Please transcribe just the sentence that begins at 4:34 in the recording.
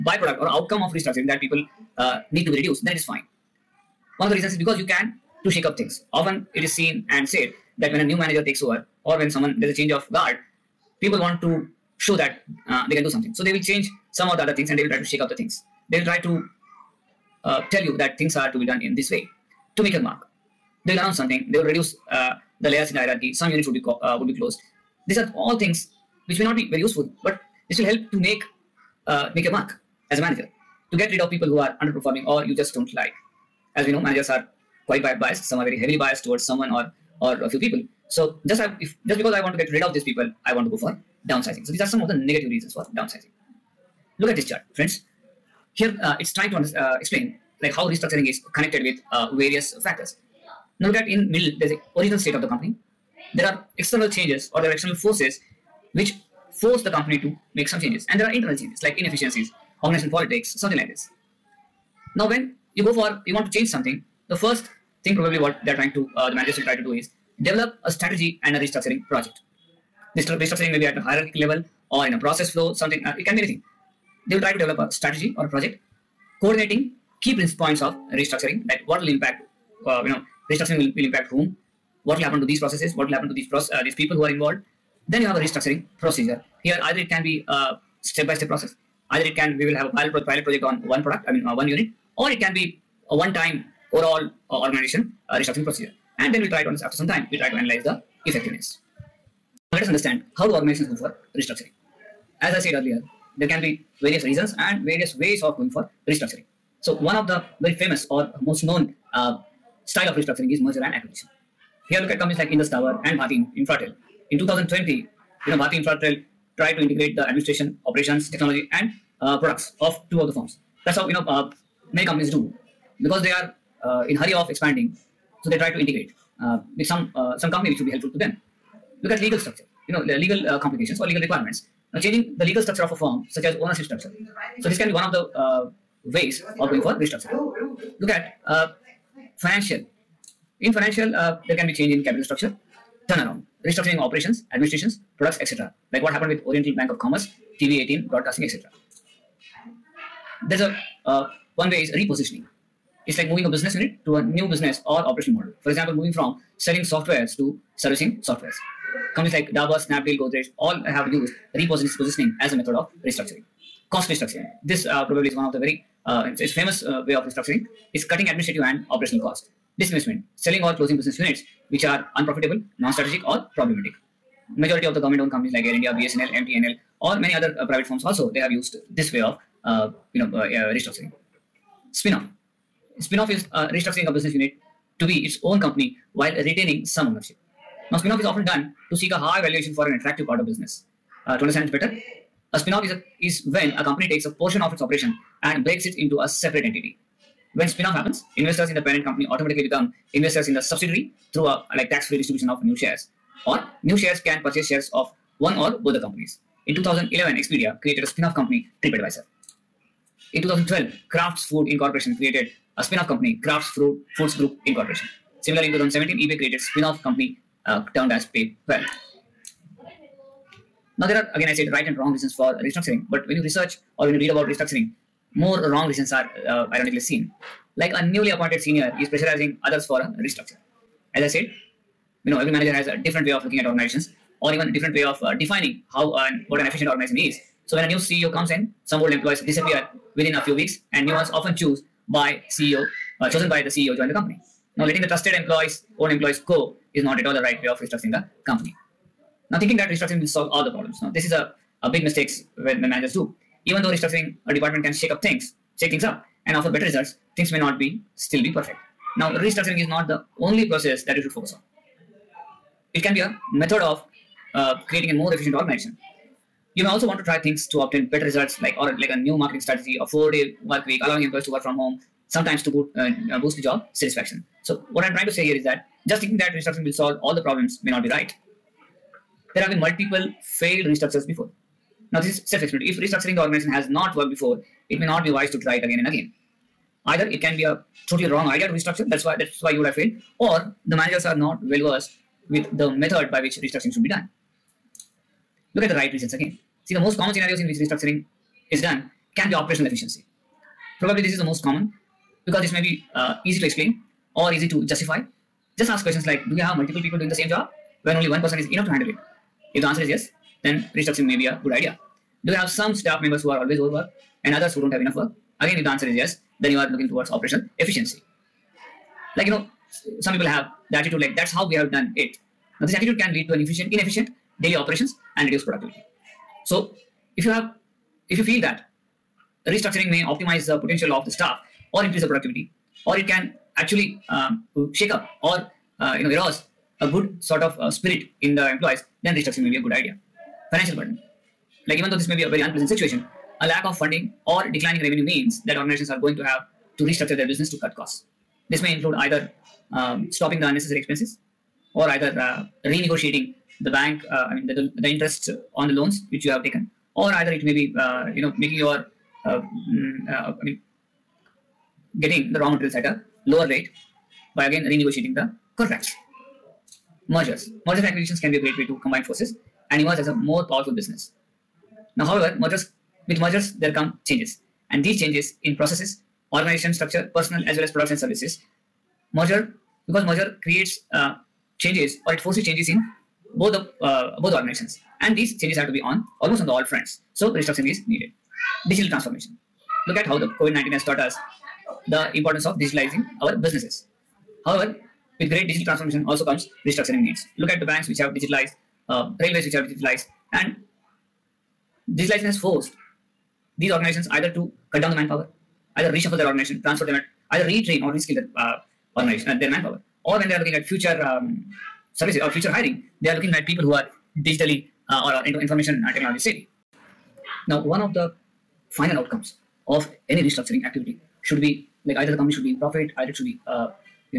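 So what I'm trying to say here is that just thinking that restructuring will solve all the problems may not be right.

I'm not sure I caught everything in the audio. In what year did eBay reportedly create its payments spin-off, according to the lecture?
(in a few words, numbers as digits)
2017.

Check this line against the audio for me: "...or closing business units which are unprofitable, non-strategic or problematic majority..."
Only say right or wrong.
right.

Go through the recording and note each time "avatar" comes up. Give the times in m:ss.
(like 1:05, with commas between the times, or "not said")
not said.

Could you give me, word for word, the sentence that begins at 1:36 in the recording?
And then we'll try to, after some time, we try to analyze the effectiveness.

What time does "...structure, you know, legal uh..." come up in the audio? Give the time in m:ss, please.
2:09.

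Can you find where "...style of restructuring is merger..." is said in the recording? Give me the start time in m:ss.
1:49.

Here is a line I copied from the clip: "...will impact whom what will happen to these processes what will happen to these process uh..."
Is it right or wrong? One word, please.
right.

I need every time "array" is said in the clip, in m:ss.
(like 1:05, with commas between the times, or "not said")
not said.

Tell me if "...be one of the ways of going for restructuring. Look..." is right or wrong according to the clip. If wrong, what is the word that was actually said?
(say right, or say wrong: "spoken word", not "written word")
right.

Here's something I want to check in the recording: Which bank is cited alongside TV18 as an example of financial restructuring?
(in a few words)
Oriental Bank of Commerce.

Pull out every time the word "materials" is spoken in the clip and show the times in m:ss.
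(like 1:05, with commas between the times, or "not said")
6:02.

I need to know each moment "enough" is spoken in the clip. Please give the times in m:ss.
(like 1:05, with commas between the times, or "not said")
5:08, 5:15.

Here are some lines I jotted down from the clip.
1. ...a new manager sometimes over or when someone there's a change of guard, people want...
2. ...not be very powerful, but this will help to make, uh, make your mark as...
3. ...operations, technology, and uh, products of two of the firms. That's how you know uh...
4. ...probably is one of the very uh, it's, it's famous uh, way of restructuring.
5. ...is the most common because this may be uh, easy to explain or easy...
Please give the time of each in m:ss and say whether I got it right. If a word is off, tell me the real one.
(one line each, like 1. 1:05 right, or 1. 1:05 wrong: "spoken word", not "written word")
1. 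0:07 wrong: "takes", not "sometimes"
2. 0:26 wrong: "useful", not "powerful"
3. 1:57 right
4. 2:45 right
5. 5:01 right.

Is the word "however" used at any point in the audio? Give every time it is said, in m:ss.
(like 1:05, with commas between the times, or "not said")
6:12, 6:34.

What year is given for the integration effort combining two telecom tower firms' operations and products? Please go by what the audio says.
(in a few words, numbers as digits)
2020.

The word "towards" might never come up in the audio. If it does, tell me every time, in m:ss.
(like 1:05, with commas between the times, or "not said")
0:36, 5:17.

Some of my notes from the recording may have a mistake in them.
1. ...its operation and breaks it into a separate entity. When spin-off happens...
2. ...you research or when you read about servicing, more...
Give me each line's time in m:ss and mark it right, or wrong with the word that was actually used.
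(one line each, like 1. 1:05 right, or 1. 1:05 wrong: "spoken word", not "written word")
1. 3:14 right
2. 3:43 wrong: "restructuring", not "servicing".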